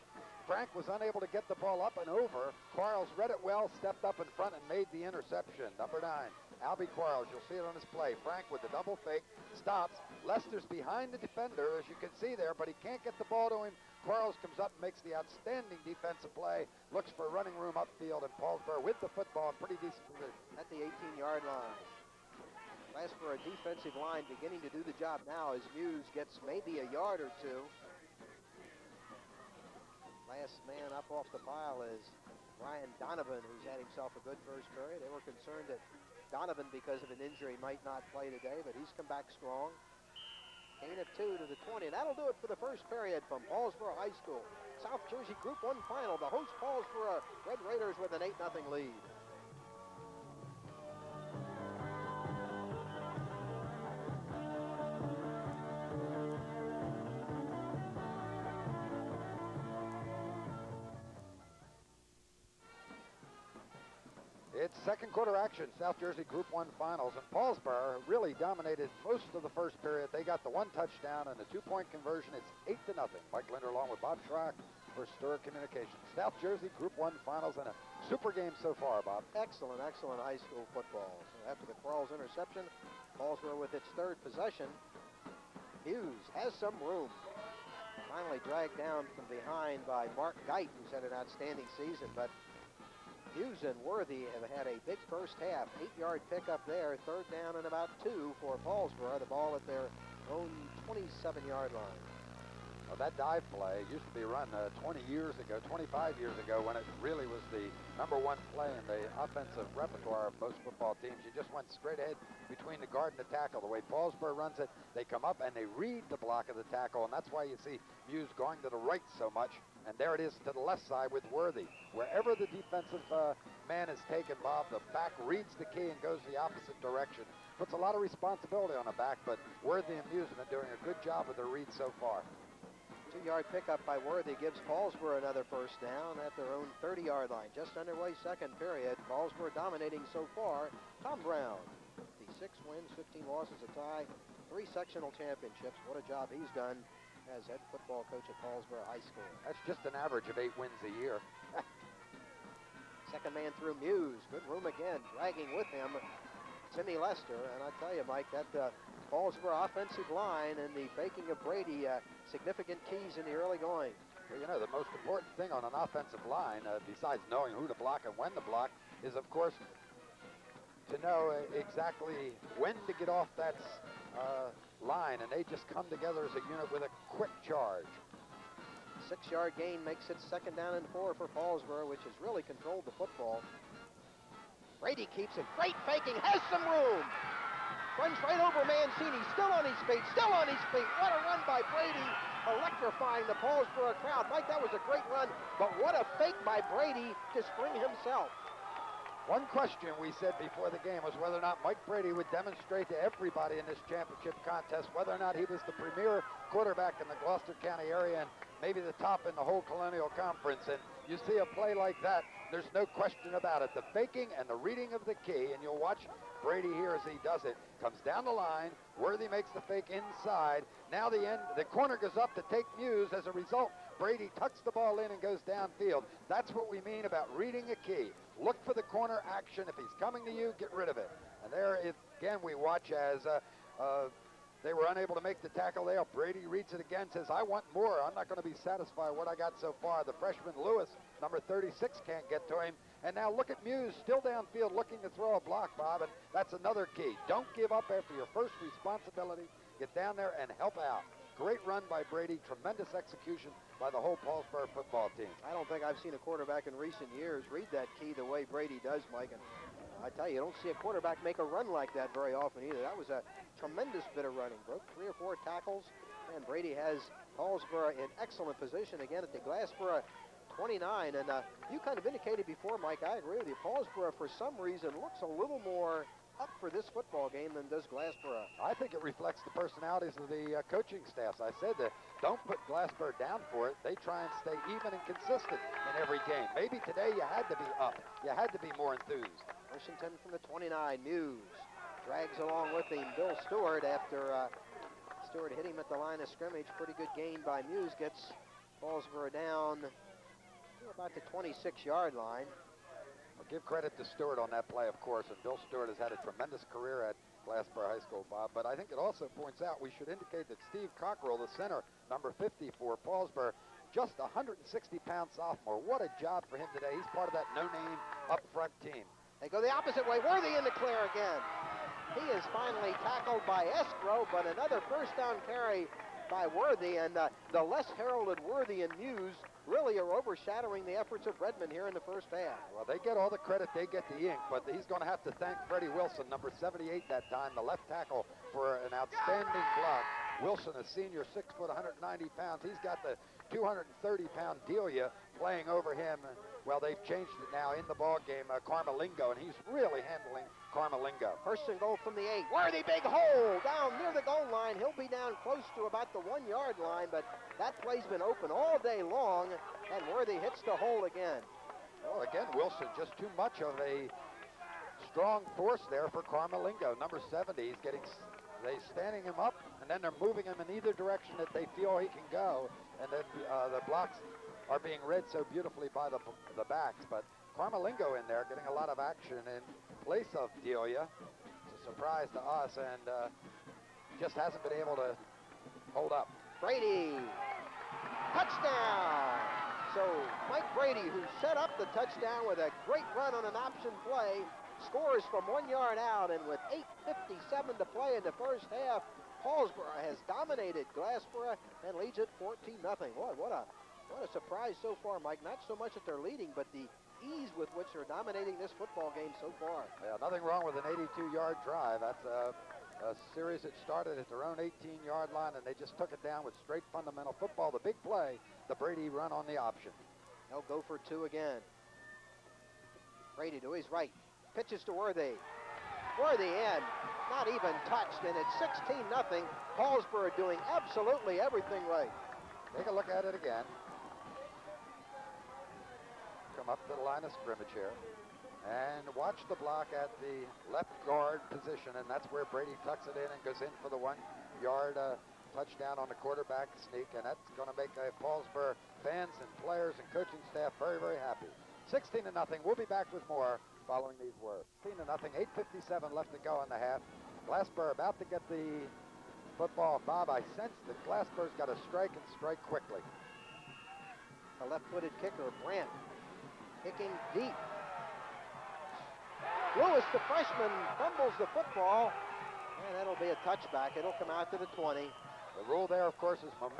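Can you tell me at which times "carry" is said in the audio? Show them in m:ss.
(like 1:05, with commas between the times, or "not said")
5:25.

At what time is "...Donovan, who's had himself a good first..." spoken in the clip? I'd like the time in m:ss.
0:32.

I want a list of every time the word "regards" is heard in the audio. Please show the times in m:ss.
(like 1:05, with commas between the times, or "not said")
not said.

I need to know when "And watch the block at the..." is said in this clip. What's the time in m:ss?
7:18.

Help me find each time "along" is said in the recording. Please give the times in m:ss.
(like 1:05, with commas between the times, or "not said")
1:13, 4:52.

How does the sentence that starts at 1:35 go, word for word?
Eight-yard pickup there, third down and about two for Paulsboro.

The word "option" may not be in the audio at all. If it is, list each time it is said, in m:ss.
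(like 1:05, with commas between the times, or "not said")
6:33, 6:59.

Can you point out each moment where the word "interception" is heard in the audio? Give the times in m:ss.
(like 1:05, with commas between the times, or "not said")
0:05, 1:22.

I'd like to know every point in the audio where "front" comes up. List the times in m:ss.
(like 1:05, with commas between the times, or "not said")
0:04, 5:18.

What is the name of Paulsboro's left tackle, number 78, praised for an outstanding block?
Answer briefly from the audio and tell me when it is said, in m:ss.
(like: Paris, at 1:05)
Freddie Wilson, at 5:35.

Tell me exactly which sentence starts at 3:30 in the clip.
And you see a play like that, there's no question about it.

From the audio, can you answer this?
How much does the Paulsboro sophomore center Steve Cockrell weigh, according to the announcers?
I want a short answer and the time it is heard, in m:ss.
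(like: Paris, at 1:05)
160 pounds, at 5:14.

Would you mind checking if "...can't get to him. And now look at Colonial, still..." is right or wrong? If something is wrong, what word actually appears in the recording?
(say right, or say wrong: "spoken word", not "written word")
wrong: "Muse", not "Colonial".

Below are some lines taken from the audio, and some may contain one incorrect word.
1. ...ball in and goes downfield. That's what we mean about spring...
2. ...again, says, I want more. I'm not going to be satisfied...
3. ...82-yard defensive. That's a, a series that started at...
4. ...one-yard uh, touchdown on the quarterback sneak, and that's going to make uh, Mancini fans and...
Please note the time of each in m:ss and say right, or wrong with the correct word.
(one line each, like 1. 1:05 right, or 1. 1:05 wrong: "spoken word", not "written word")
1. 3:44 wrong: "reading", not "spring"
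2. 3:56 right
3. 6:50 wrong: "drive", not "defensive"
4. 7:23 wrong: "Paulsboro", not "Mancini".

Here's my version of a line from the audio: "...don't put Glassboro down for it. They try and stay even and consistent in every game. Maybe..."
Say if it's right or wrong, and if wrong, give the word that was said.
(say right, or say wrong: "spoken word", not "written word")
right.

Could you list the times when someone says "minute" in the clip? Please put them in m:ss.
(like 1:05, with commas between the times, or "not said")
not said.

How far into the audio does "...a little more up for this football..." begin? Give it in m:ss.
4:35.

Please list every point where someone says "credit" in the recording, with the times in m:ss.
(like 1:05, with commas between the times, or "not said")
5:03, 5:33.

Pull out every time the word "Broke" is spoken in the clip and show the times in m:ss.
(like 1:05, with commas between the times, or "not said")
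4:24.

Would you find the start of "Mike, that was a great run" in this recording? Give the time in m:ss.
3:14.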